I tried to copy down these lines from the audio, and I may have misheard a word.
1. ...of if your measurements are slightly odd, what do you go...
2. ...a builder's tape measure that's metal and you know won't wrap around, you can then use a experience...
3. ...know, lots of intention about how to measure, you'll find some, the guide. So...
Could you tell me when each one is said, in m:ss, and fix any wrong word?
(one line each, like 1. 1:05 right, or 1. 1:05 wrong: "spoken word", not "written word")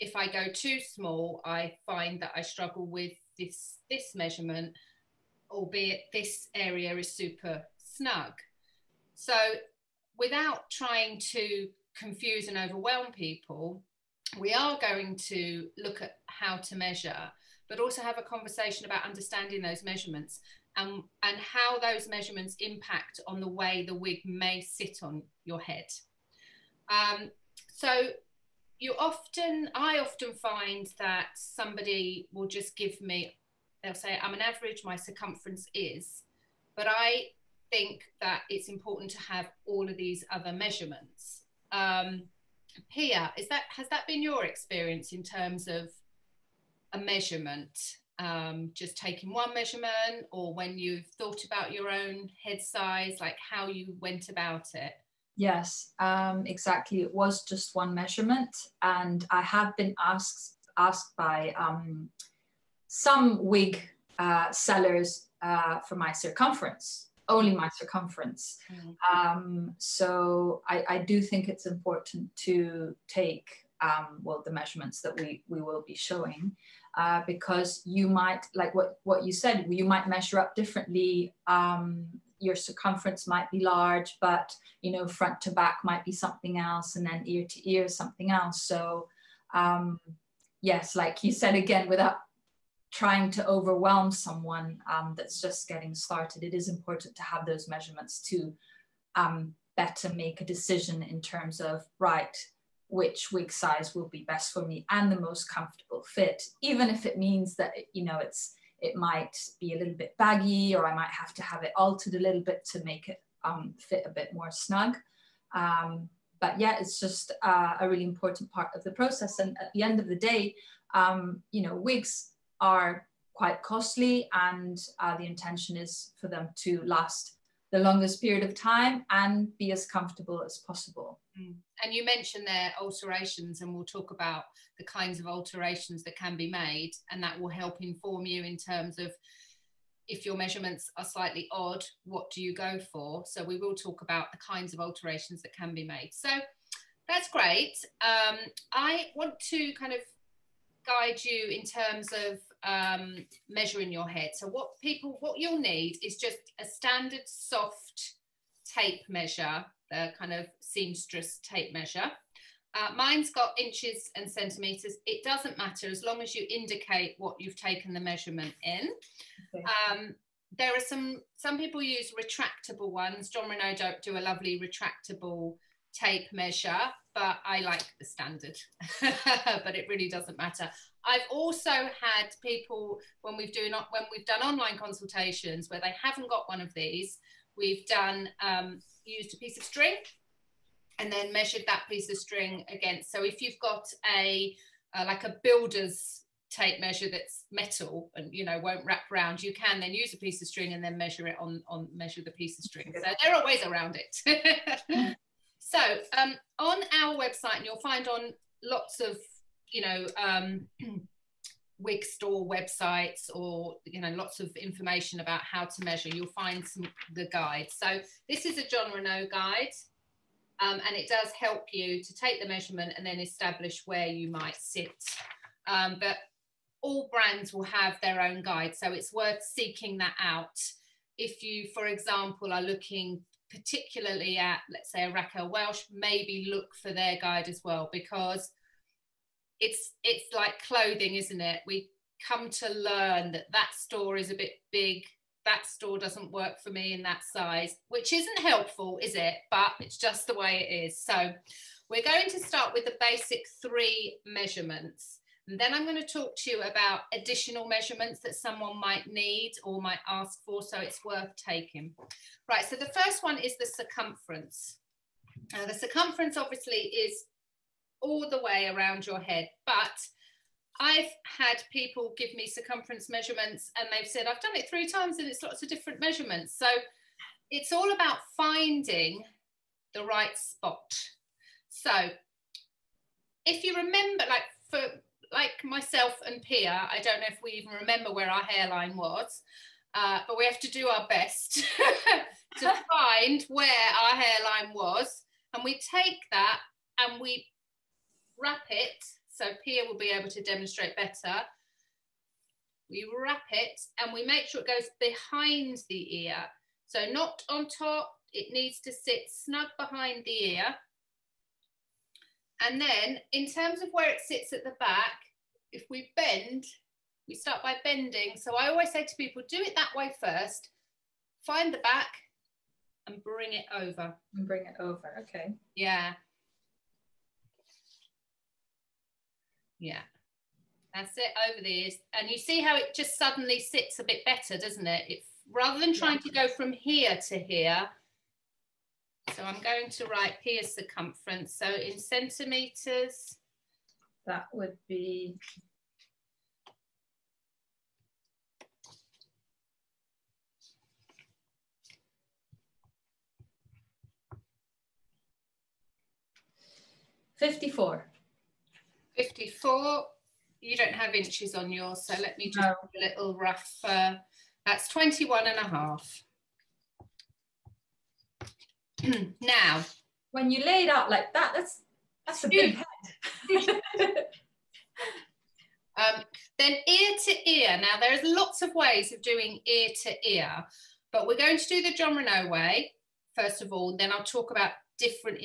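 1. 2:18 right
2. 3:15 wrong: "piece", not "experience"
3. 3:34 wrong: "information", not "intention".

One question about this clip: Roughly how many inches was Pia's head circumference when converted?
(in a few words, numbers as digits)
21.5.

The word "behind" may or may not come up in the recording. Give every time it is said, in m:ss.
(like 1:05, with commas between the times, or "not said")
5:05, 5:09.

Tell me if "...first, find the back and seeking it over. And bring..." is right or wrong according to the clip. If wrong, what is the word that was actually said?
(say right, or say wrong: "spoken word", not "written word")
wrong: "bring", not "seeking".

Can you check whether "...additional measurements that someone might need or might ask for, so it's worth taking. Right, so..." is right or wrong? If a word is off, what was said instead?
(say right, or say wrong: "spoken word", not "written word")
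right.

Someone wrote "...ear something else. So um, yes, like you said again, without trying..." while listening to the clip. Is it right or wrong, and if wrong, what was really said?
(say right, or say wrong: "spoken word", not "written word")
right.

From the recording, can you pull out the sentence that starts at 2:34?
So what people, what you'll need is just a standard soft tape measure, the kind of seamstress tape measure.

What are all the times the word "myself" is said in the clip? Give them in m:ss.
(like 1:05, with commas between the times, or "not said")
4:45.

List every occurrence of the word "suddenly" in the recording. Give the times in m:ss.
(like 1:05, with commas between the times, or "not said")
5:33.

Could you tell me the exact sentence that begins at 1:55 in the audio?
Um, but yeah, it's just uh, a really important part of the process.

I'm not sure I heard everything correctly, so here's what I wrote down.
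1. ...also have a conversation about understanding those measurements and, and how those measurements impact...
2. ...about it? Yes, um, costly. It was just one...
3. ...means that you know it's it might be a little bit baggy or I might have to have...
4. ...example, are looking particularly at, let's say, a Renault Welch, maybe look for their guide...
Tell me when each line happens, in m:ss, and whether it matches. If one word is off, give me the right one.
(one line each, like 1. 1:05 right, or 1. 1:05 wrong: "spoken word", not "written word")
1. 0:17 right
2. 0:54 wrong: "exactly", not "costly"
3. 1:47 right
4. 3:51 wrong: "Raquel", not "Renault".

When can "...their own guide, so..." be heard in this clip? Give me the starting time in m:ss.
3:48.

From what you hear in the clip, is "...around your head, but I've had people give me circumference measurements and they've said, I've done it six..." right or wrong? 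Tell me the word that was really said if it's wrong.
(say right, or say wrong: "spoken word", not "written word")
wrong: "three", not "six".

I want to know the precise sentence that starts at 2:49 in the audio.
Um, there are some, some people use retractable ones.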